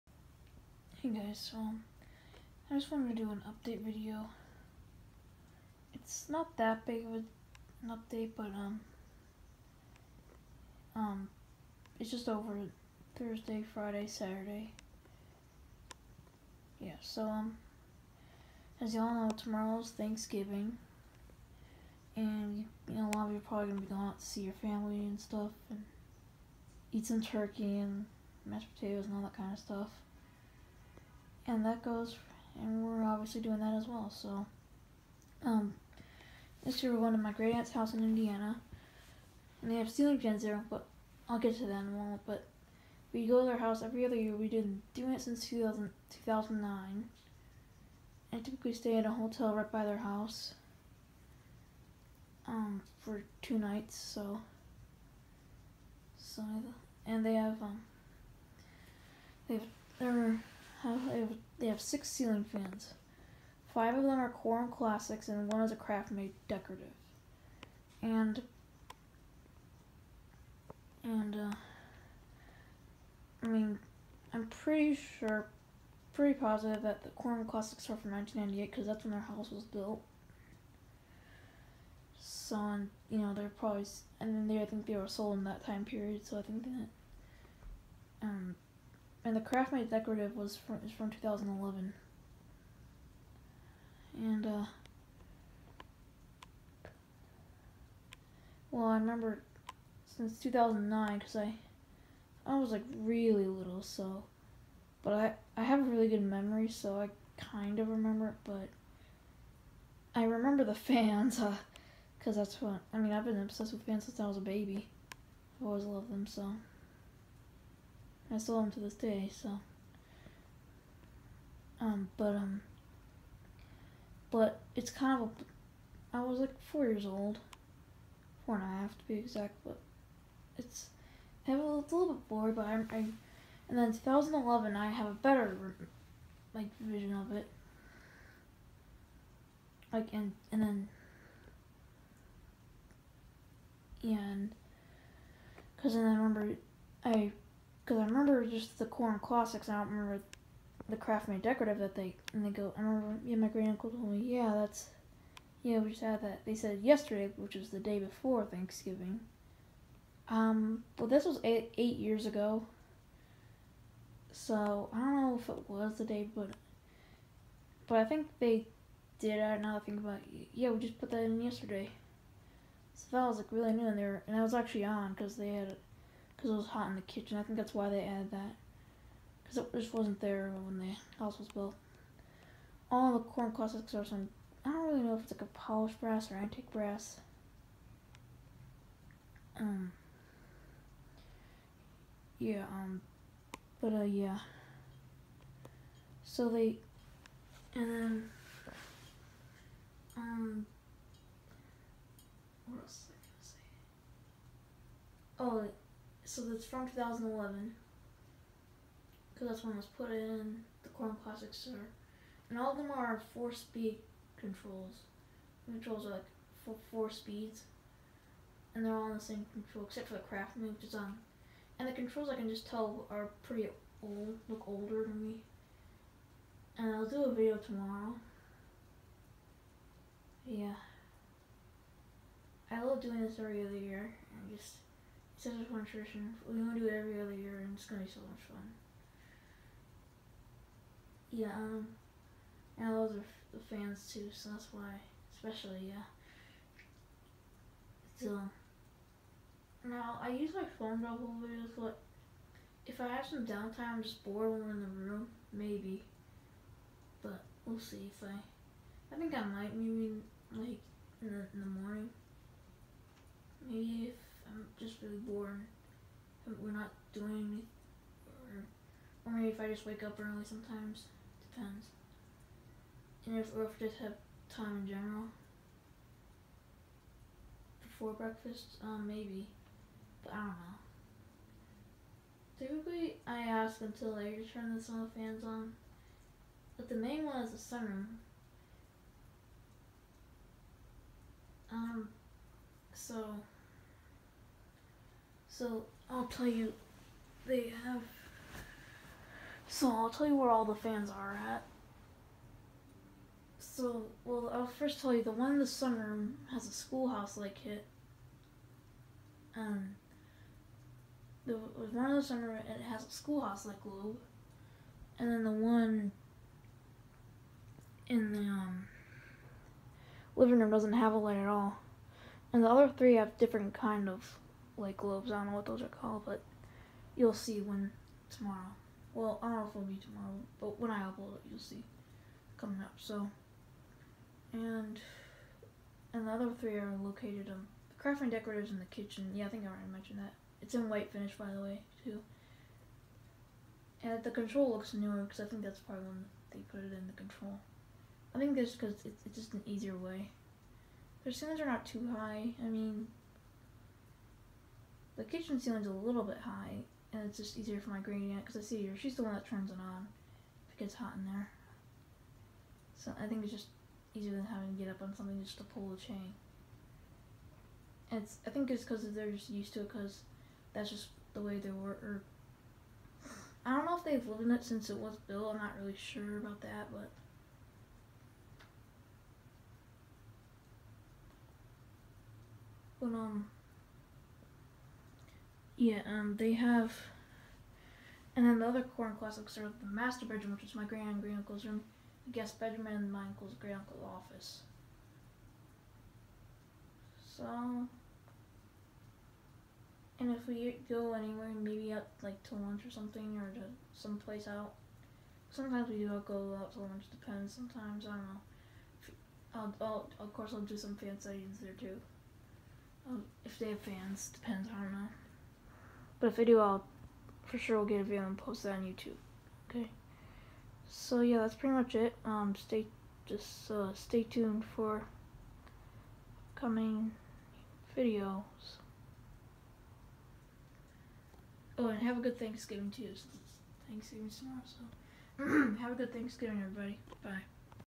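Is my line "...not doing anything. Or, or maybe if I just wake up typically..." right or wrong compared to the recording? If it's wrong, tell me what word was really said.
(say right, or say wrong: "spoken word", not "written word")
wrong: "early", not "typically".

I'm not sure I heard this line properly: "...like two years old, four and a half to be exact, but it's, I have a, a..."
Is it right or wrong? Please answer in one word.
wrong.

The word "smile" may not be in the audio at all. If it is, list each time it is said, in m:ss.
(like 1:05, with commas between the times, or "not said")
not said.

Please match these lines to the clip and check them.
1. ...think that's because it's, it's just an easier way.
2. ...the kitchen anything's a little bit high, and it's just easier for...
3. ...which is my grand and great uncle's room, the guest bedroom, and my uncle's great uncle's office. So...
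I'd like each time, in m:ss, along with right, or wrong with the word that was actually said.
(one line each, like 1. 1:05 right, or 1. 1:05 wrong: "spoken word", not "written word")
1. 5:48 right
2. 5:55 wrong: "ceiling", not "anything"
3. 6:30 right.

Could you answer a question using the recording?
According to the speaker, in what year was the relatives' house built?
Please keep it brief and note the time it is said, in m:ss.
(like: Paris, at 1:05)
1998, at 1:18.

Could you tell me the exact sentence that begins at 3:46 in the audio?
And I'll do a video tomorrow.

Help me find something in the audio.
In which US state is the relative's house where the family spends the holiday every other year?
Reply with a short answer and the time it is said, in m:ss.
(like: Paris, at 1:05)
Indiana, at 0:38.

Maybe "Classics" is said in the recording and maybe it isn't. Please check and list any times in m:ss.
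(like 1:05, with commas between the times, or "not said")
1:04, 1:17, 2:29, 3:03, 3:31, 6:29.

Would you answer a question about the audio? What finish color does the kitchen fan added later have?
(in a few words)
white.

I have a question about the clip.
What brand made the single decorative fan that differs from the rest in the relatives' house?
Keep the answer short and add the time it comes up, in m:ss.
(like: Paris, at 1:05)
Craftmade, at 1:05.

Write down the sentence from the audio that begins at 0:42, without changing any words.
But we go to their house every other year.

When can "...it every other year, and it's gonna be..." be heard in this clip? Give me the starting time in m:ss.
3:56.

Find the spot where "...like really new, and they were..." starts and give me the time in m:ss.
2:53.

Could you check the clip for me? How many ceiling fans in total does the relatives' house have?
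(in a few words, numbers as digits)
6.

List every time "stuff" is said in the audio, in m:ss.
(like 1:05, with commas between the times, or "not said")
0:25, 0:29.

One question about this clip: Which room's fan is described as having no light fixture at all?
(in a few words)
living room.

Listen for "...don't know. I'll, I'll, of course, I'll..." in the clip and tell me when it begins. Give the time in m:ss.
6:48.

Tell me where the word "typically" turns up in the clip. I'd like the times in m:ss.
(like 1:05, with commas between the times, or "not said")
0:48, 4:42.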